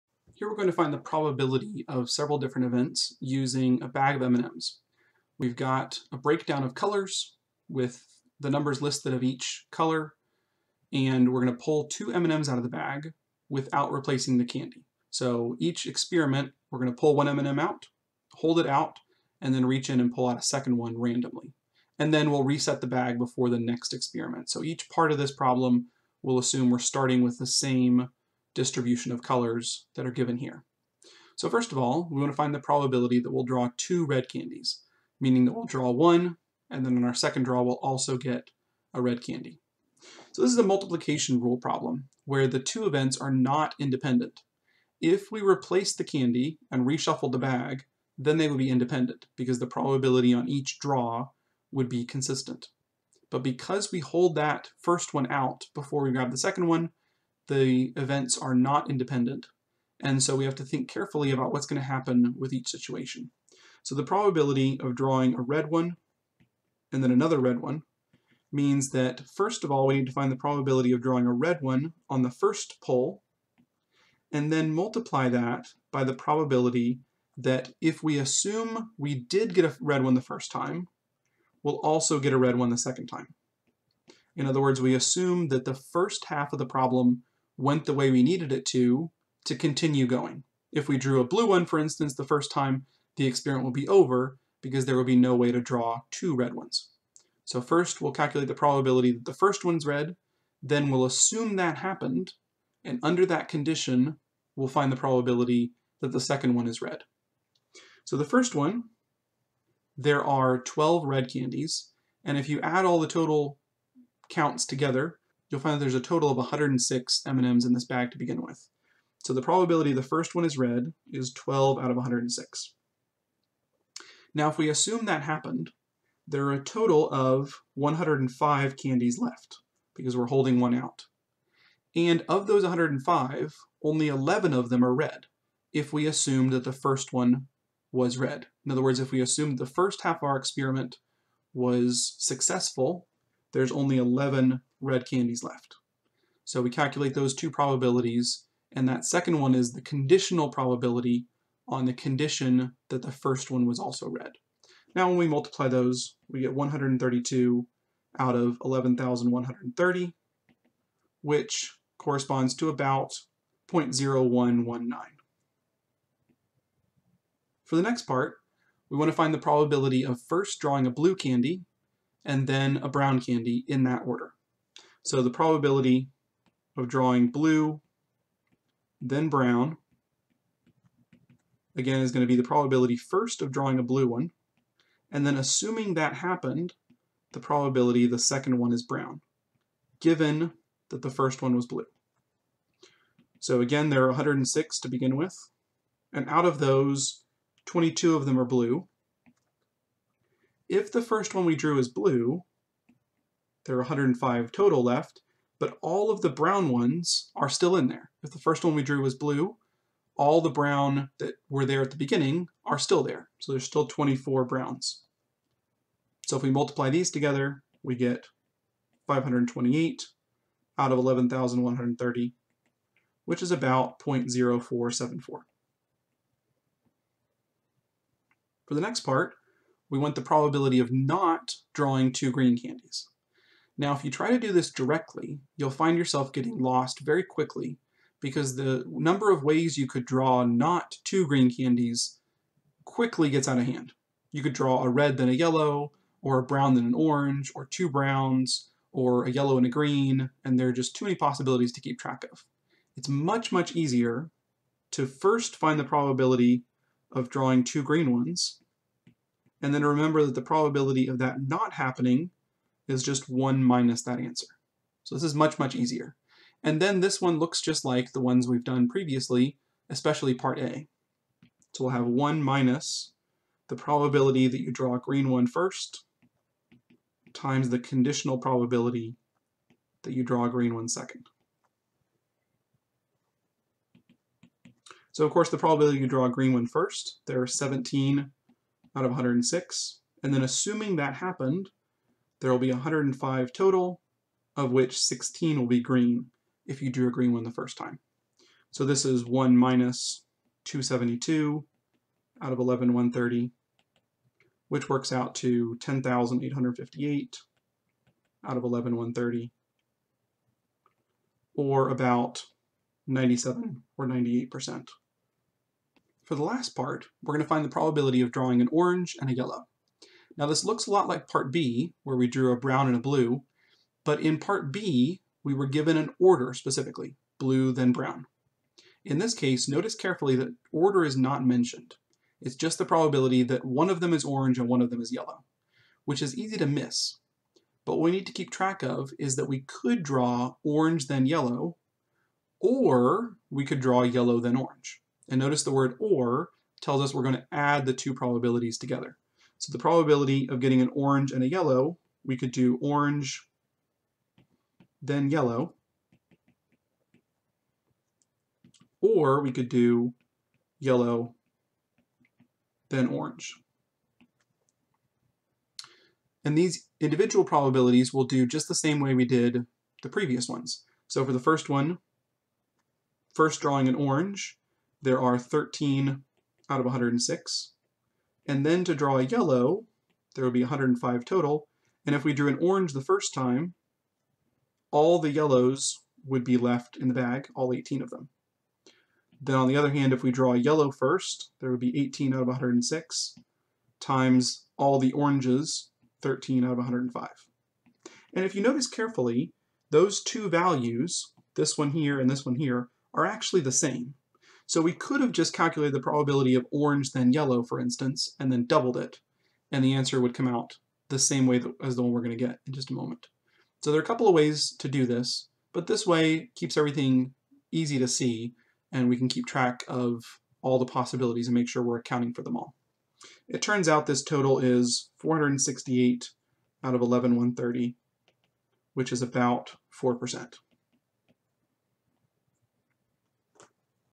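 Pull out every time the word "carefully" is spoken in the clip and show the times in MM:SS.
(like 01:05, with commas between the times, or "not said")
01:00, 05:29, 06:38.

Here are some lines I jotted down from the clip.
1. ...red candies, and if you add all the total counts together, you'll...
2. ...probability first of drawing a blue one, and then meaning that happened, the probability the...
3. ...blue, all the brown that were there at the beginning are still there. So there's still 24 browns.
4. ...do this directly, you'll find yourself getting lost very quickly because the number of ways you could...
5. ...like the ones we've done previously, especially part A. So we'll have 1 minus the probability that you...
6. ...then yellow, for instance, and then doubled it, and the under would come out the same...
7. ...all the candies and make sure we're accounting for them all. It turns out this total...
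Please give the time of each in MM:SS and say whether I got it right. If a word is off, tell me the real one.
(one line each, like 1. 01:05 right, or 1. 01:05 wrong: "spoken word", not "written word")
1. 01:51 right
2. 03:02 wrong: "assuming", not "meaning"
3. 03:29 right
4. 03:54 right
5. 04:27 right
6. 06:47 wrong: "answer", not "under"
7. 07:00 wrong: "possibilities", not "candies".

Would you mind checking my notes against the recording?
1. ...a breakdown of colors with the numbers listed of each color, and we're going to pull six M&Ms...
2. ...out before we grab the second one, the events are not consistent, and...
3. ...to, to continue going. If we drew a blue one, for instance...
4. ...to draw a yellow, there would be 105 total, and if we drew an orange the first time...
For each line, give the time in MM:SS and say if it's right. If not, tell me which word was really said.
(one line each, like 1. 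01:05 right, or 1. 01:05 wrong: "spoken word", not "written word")
1. 00:06 wrong: "two", not "six"
2. 00:55 wrong: "independent", not "consistent"
3. 01:28 right
4. 06:18 right.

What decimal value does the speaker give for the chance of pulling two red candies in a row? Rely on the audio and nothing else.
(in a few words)
0.0119.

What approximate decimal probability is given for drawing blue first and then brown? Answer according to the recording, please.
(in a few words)
0.0474.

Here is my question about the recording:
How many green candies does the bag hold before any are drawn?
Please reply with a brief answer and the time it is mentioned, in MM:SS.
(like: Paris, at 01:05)
17, at 04:47.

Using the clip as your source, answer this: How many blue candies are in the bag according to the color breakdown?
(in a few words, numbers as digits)
22.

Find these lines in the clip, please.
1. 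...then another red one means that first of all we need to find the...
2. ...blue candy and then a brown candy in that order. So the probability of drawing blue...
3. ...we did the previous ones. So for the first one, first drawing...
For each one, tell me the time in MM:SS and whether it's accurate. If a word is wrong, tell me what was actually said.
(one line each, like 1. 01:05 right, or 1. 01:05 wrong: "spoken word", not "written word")
1. 01:07 right
2. 02:50 right
3. 06:09 right.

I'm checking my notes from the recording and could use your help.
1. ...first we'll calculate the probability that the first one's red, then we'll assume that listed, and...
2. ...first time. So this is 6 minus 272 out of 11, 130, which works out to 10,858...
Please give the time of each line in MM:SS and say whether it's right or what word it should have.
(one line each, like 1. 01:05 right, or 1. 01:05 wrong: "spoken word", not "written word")
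1. 01:37 wrong: "happened", not "listed"
2. 04:57 wrong: "1", not "6".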